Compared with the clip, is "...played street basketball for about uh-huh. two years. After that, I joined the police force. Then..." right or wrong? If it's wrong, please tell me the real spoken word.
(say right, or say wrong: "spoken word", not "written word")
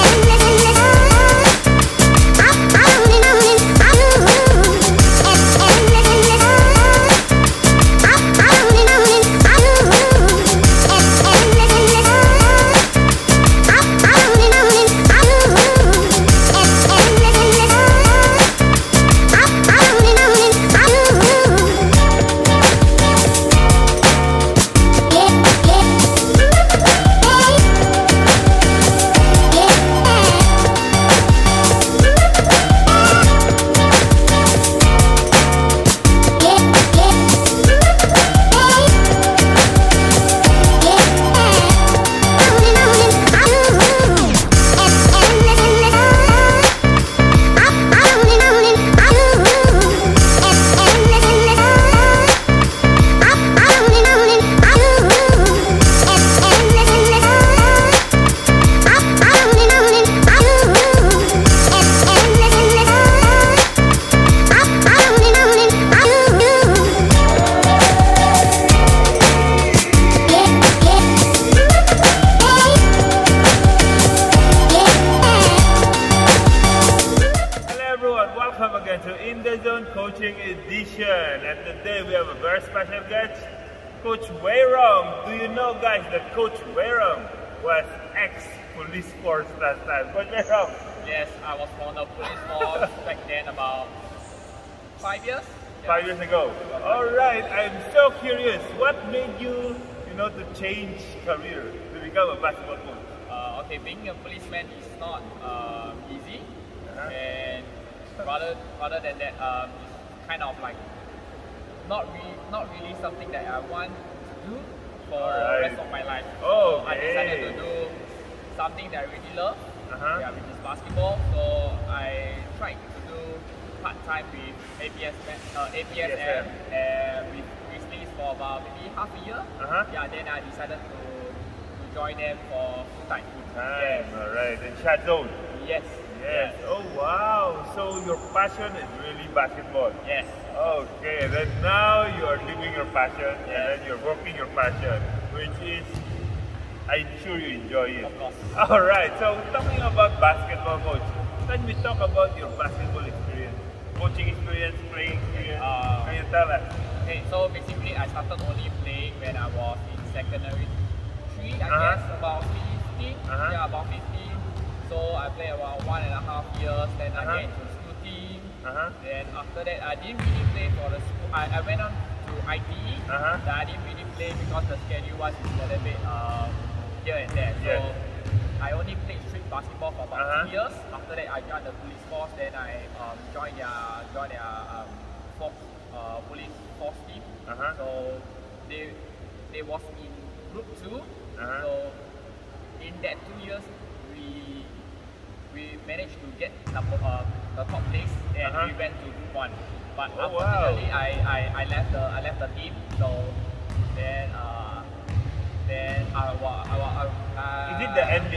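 right.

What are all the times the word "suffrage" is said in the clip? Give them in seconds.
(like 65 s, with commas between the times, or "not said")
not said.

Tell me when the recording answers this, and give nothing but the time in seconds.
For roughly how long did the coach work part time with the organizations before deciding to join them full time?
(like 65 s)
128 s.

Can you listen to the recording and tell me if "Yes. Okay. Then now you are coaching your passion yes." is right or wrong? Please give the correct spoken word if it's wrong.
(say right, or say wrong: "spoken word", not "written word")
wrong: "living", not "coaching".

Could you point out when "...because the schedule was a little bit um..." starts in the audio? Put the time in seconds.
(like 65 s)
174 s.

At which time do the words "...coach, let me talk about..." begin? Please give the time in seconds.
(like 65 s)
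150 s.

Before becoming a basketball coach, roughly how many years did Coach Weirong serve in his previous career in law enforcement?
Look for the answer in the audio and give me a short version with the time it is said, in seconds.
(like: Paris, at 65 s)
5 years, at 93 s.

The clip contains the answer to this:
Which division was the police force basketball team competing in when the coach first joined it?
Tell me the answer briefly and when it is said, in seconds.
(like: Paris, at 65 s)
Group 2, at 190 s.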